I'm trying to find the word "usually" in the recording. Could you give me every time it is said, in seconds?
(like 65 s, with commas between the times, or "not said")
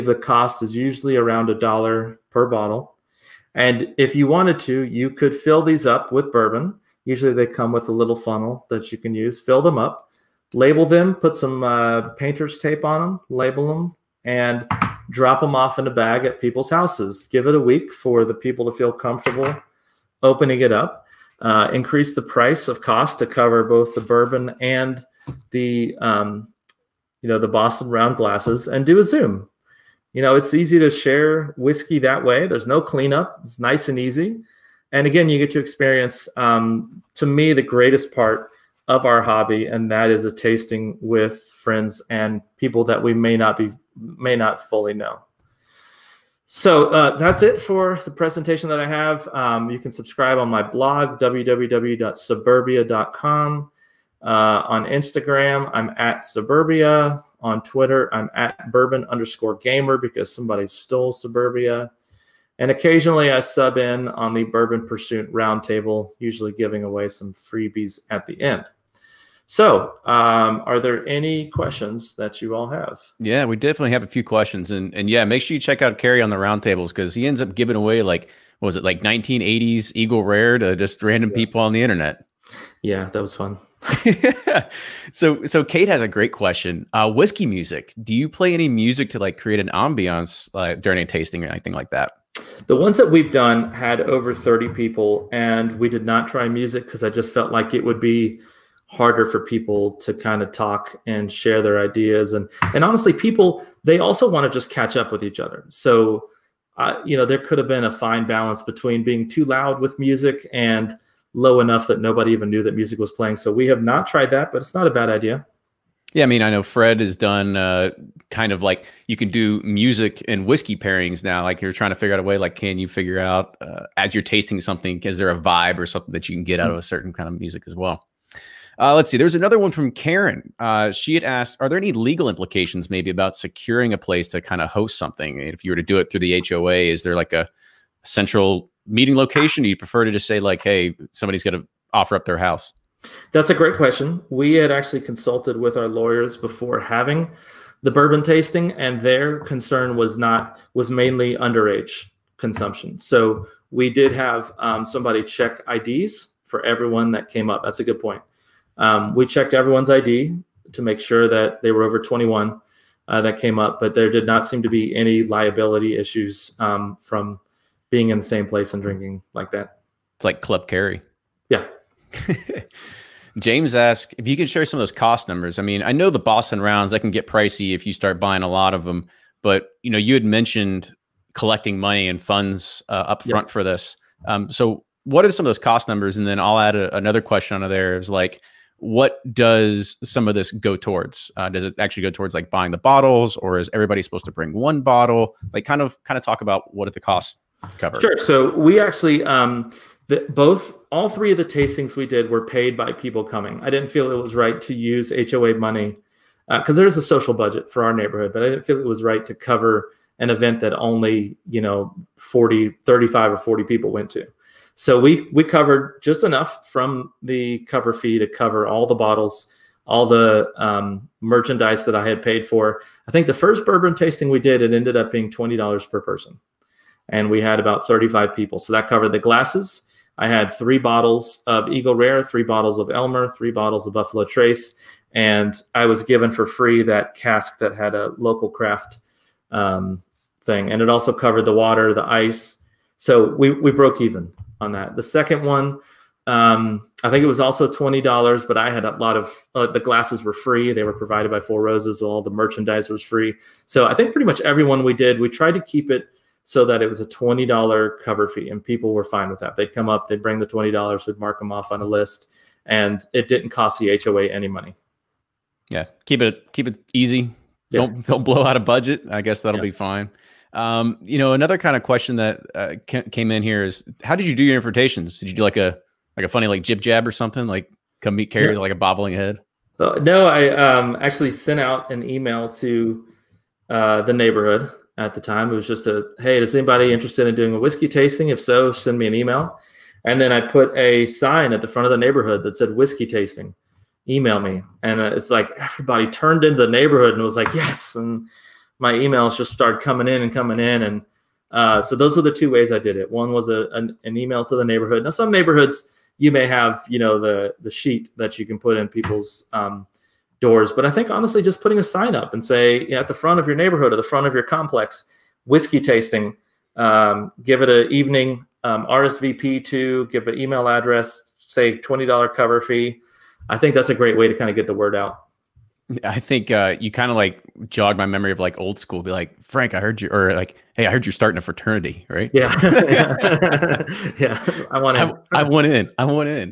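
0 s, 7 s, 66 s.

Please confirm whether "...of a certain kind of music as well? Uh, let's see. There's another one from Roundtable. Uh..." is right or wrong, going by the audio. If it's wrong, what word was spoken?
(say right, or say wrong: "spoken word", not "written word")
wrong: "Karen", not "Roundtable".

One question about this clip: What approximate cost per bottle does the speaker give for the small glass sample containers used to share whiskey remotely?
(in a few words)
A dollar.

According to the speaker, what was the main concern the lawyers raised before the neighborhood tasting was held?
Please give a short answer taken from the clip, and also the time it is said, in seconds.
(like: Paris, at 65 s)
Underage consumption, at 151 s.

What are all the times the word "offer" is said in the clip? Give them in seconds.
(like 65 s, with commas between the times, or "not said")
141 s.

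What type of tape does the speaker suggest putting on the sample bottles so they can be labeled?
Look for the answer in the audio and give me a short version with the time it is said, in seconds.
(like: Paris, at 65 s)
Painter's tape, at 12 s.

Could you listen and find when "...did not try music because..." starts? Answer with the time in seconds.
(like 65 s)
95 s.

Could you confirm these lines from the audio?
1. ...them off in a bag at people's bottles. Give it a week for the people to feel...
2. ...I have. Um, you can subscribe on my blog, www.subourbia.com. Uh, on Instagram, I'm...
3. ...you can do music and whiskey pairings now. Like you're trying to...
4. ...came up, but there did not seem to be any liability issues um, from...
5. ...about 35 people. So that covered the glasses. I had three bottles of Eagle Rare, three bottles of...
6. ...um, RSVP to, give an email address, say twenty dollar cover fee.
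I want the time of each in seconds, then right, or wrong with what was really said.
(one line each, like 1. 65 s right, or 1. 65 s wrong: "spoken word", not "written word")
1. 15 s wrong: "houses", not "bottles"
2. 48 s right
3. 119 s right
4. 163 s right
5. 227 s right
6. 318 s right.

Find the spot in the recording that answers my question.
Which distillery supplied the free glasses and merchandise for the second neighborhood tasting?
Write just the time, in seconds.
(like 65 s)
251 s.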